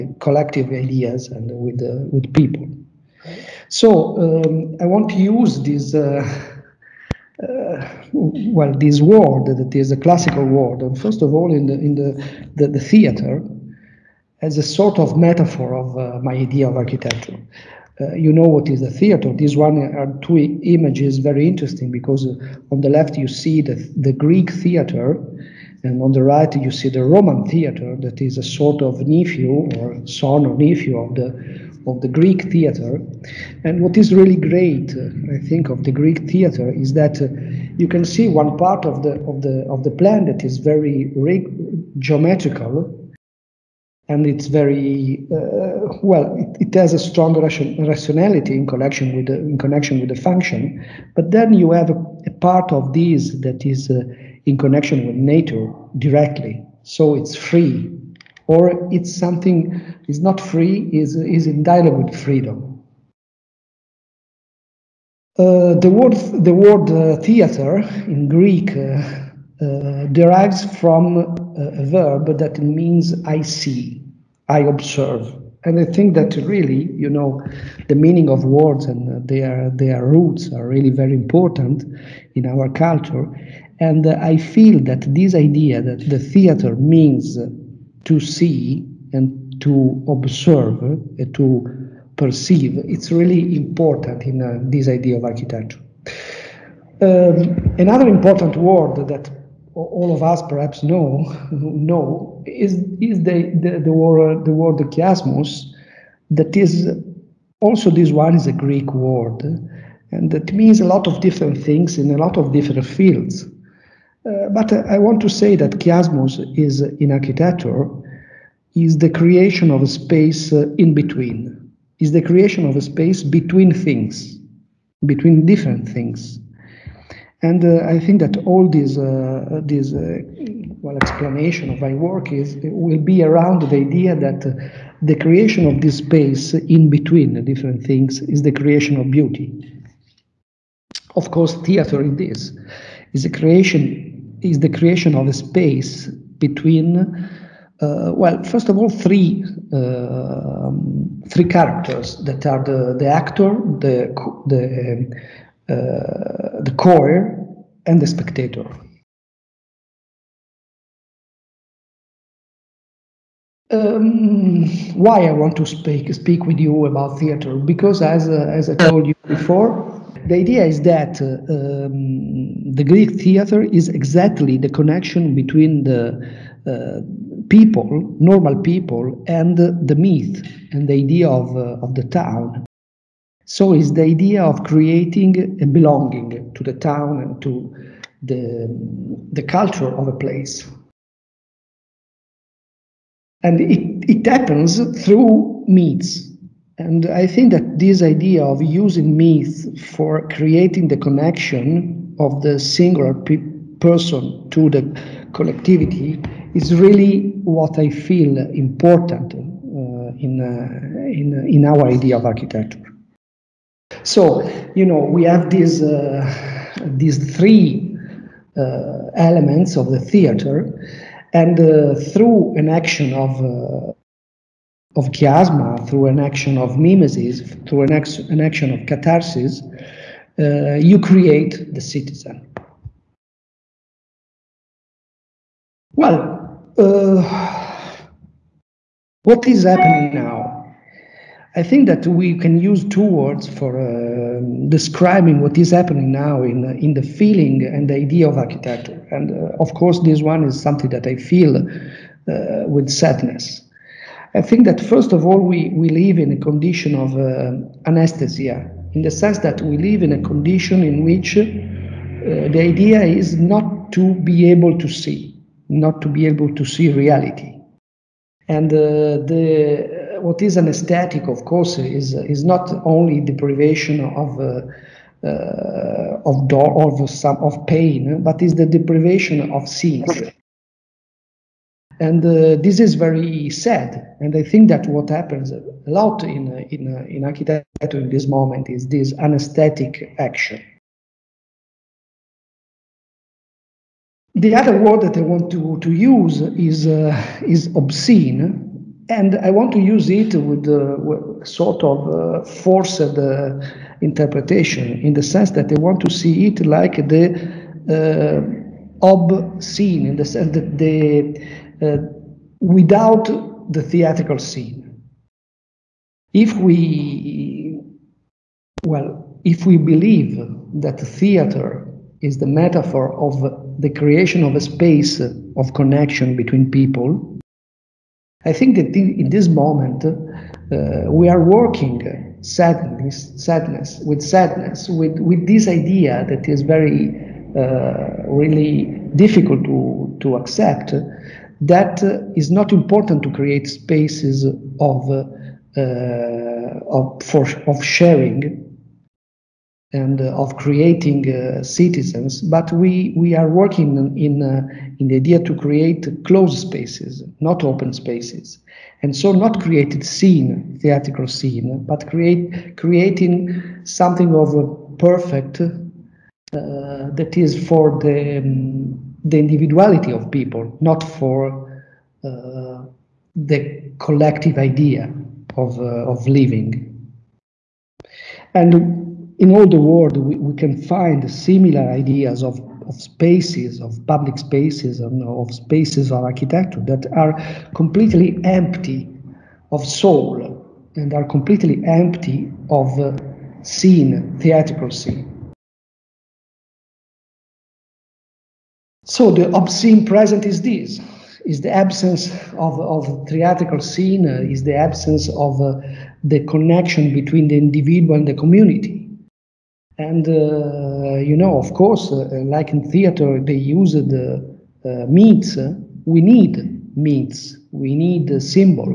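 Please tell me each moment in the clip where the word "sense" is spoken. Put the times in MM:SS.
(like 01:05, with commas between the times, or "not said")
04:19, 04:39, 05:05, 05:10.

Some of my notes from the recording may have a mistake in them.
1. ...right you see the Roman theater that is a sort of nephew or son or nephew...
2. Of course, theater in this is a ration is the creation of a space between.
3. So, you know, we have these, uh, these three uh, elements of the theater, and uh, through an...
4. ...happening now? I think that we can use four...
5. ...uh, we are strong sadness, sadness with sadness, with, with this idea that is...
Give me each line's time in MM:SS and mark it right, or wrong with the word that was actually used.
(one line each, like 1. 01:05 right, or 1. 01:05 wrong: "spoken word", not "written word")
1. 00:26 right
2. 02:21 wrong: "creation", not "ration"
3. 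03:34 right
4. 03:59 wrong: "two", not "four"
5. 05:30 wrong: "working", not "strong".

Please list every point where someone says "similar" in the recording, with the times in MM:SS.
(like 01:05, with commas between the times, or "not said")
06:21.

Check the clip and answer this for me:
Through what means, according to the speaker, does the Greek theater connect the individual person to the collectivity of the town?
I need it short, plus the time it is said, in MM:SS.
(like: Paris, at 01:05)
myths, at 03:15.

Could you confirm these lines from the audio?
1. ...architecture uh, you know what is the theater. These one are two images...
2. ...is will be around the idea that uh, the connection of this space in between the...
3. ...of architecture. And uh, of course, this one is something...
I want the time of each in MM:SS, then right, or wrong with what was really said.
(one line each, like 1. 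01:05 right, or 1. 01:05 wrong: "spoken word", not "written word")
1. 00:16 right
2. 02:12 wrong: "creation", not "connection"
3. 04:08 right.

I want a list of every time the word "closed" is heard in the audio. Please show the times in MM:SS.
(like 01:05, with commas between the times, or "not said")
05:56.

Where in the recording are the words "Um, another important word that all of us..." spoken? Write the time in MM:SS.
01:37.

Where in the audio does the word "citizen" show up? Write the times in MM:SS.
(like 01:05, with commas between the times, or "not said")
03:51, 05:51.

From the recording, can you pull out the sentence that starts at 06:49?
And, uh, you know, of course, uh, like in theater, they use the uh, means.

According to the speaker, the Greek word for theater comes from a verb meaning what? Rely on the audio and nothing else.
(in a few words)
I see, I observe.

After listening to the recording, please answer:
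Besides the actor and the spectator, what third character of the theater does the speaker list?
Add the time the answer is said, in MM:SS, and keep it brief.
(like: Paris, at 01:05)
the choir, at 02:36.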